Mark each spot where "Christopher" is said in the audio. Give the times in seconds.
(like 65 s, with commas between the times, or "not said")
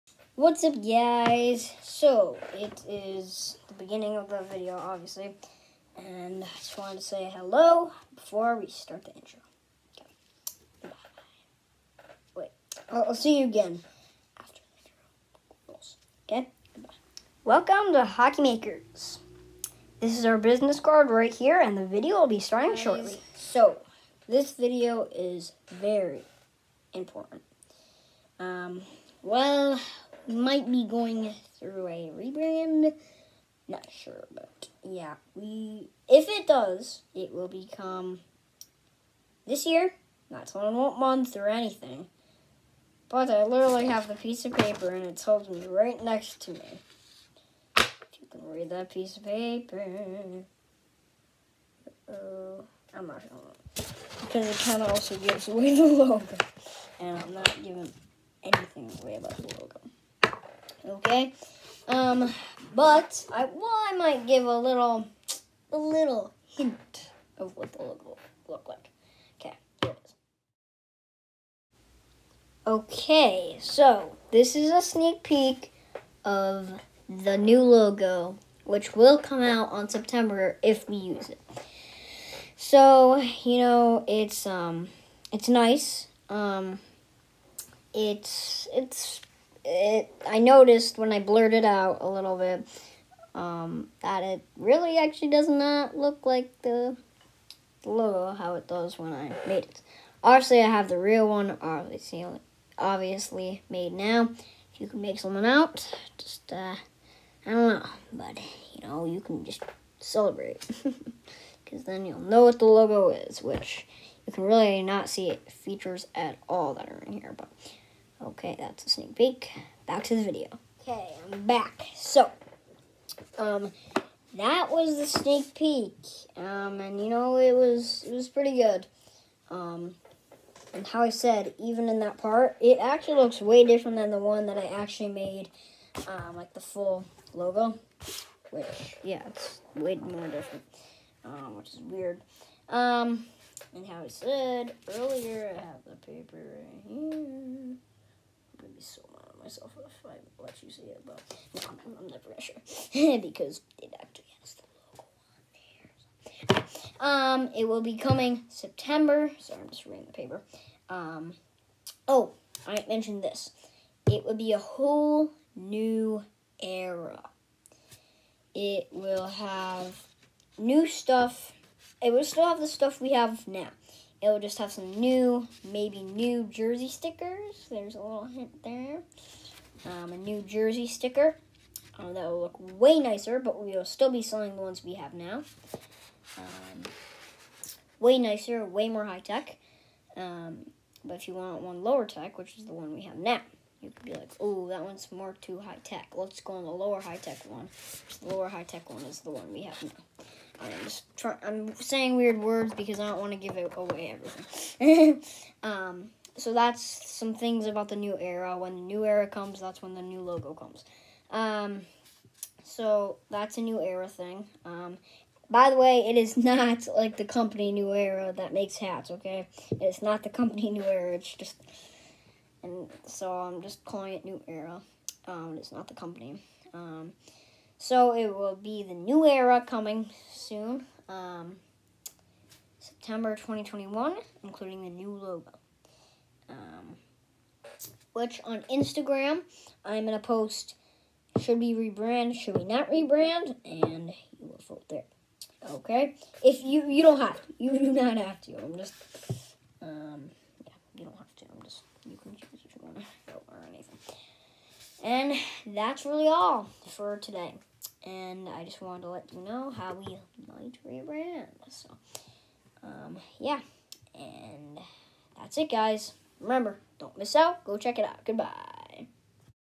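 not said.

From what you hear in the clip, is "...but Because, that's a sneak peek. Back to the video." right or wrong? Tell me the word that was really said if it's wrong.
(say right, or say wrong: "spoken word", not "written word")
wrong: "Okay", not "Because".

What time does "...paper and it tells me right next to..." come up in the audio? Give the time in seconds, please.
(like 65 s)
44 s.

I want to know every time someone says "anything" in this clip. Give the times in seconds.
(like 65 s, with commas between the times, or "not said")
41 s, 58 s, 253 s.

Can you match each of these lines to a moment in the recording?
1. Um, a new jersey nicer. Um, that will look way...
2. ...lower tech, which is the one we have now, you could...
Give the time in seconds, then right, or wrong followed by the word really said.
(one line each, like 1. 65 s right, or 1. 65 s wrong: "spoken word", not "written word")
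1. 179 s wrong: "sticker", not "nicer"
2. 191 s right.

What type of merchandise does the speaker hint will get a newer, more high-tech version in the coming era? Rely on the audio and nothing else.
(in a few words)
Jersey stickers.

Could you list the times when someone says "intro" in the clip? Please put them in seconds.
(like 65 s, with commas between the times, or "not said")
9 s, 15 s.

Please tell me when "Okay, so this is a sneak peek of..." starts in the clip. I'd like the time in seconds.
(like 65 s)
72 s.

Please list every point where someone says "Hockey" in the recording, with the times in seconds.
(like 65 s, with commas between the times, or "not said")
18 s.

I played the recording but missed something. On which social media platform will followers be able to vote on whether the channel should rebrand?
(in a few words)
Instagram.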